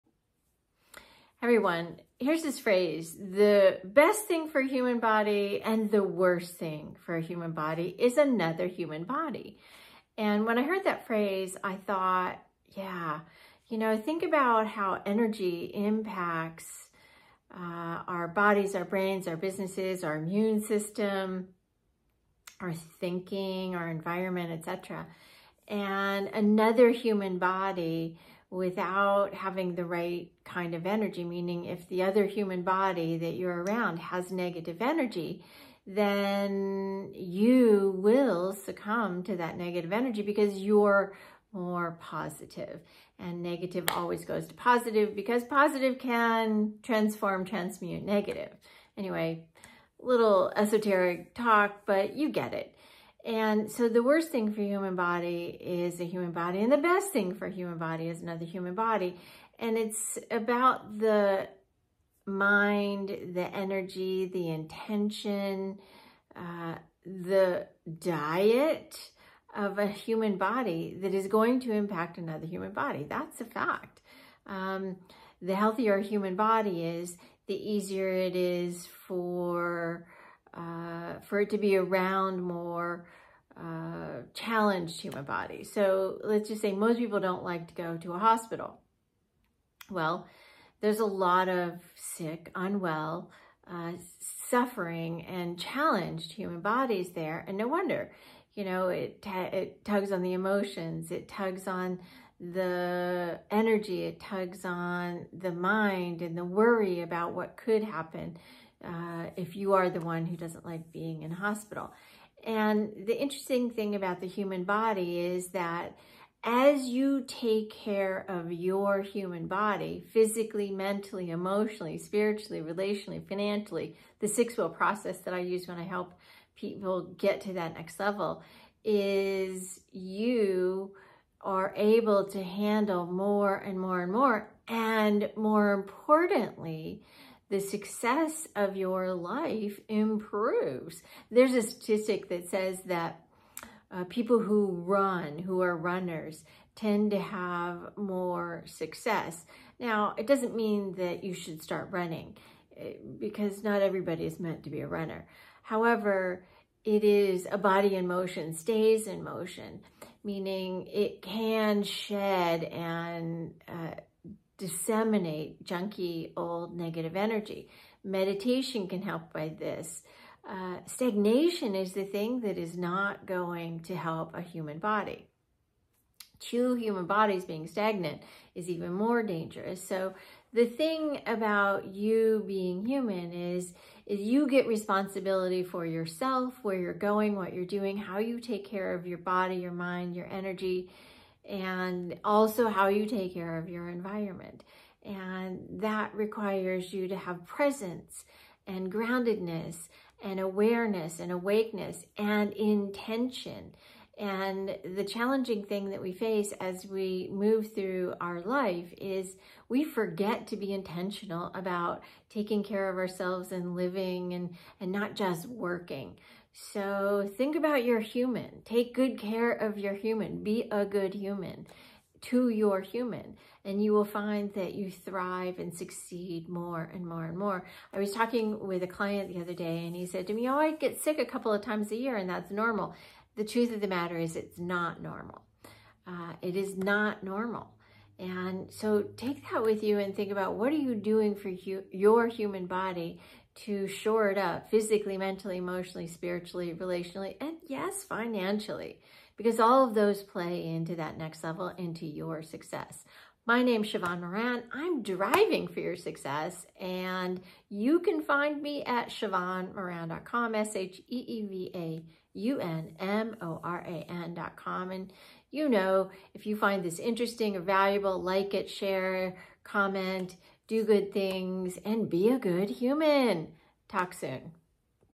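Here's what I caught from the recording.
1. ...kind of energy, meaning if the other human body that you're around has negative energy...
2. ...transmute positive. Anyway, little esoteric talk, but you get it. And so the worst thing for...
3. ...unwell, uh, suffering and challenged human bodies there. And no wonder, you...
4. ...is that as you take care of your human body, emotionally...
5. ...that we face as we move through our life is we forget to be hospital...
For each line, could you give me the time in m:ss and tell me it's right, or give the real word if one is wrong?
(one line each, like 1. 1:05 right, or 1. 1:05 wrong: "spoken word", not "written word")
1. 0:30 right
2. 0:47 wrong: "negative", not "positive"
3. 1:32 right
4. 1:55 wrong: "physically", not "emotionally"
5. 3:25 wrong: "intentional", not "hospital".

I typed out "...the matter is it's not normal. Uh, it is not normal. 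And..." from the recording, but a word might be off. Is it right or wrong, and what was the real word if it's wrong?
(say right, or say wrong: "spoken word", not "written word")
right.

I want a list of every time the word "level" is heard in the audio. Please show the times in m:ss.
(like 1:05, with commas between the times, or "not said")
2:07, 4:11.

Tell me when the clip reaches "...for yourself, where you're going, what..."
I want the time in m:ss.
3:05.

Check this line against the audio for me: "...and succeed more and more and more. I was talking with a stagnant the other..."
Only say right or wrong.
wrong.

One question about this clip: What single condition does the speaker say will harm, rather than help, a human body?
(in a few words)
Stagnation.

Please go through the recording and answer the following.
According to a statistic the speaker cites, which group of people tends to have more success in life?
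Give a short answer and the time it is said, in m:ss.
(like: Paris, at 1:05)
Runners, at 2:25.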